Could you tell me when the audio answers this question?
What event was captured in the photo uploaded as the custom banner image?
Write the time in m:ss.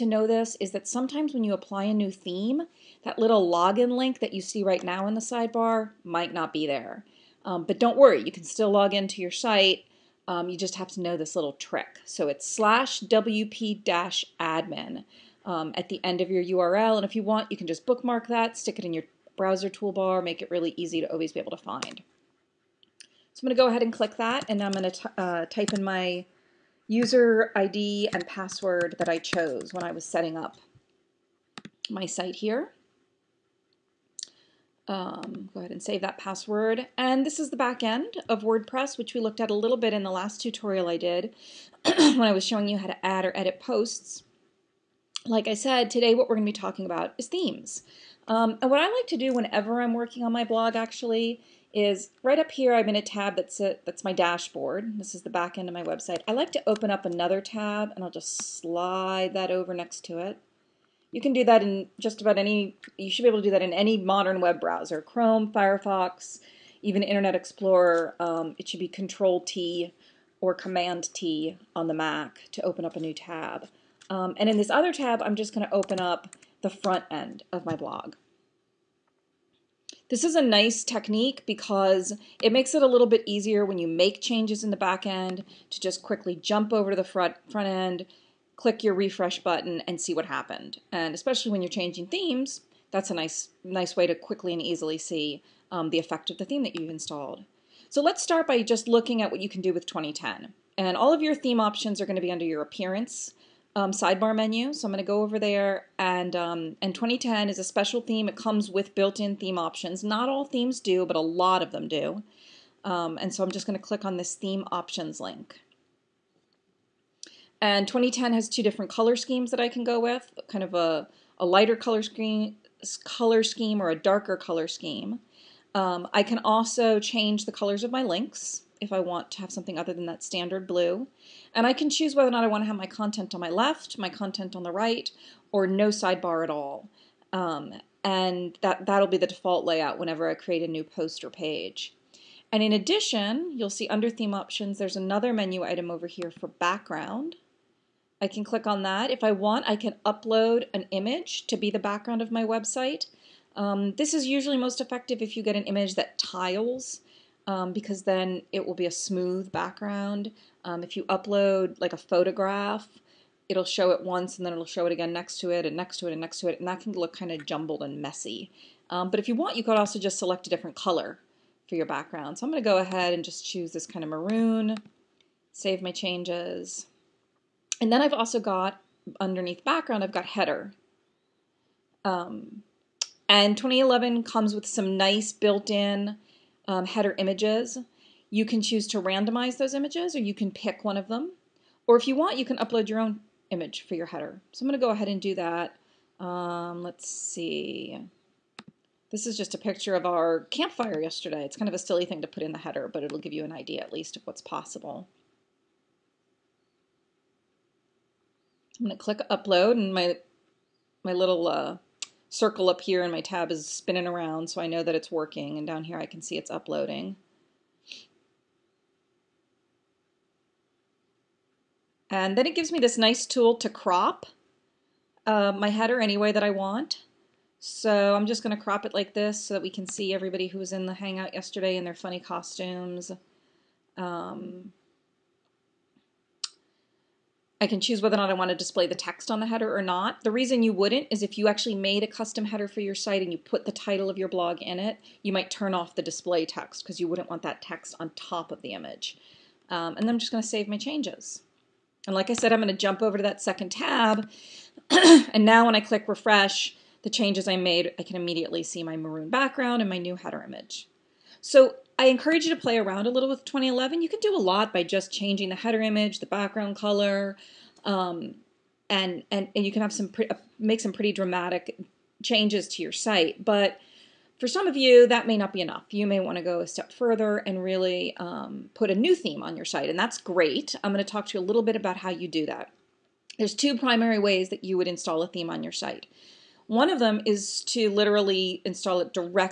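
3:20.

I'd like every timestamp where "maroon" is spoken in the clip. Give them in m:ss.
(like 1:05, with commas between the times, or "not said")
2:54, 4:18.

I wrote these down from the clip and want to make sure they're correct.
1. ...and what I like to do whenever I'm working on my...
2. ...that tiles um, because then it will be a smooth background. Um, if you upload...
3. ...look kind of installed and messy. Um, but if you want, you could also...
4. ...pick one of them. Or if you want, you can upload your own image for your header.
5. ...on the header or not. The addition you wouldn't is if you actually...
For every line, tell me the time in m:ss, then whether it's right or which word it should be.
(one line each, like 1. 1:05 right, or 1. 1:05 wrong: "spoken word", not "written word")
1. 0:48 right
2. 2:35 right
3. 2:46 wrong: "jumbled", not "installed"
4. 3:10 right
5. 3:59 wrong: "reason", not "addition".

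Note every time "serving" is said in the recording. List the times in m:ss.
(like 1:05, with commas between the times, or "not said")
not said.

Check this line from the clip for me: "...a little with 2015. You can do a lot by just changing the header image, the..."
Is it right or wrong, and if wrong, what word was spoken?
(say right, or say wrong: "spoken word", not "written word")
wrong: "2011", not "2015".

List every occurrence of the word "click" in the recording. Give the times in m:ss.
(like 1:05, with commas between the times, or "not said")
0:23, 1:28, 1:53, 2:28, 3:29, 4:15.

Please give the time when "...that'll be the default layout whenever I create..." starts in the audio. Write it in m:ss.
2:18.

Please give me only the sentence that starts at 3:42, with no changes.
And then it gives me this nice tool to crop uh, my header any way that I want.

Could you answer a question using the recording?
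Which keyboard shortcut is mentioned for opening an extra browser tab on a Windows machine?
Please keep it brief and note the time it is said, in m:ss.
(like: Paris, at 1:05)
Control T, at 1:08.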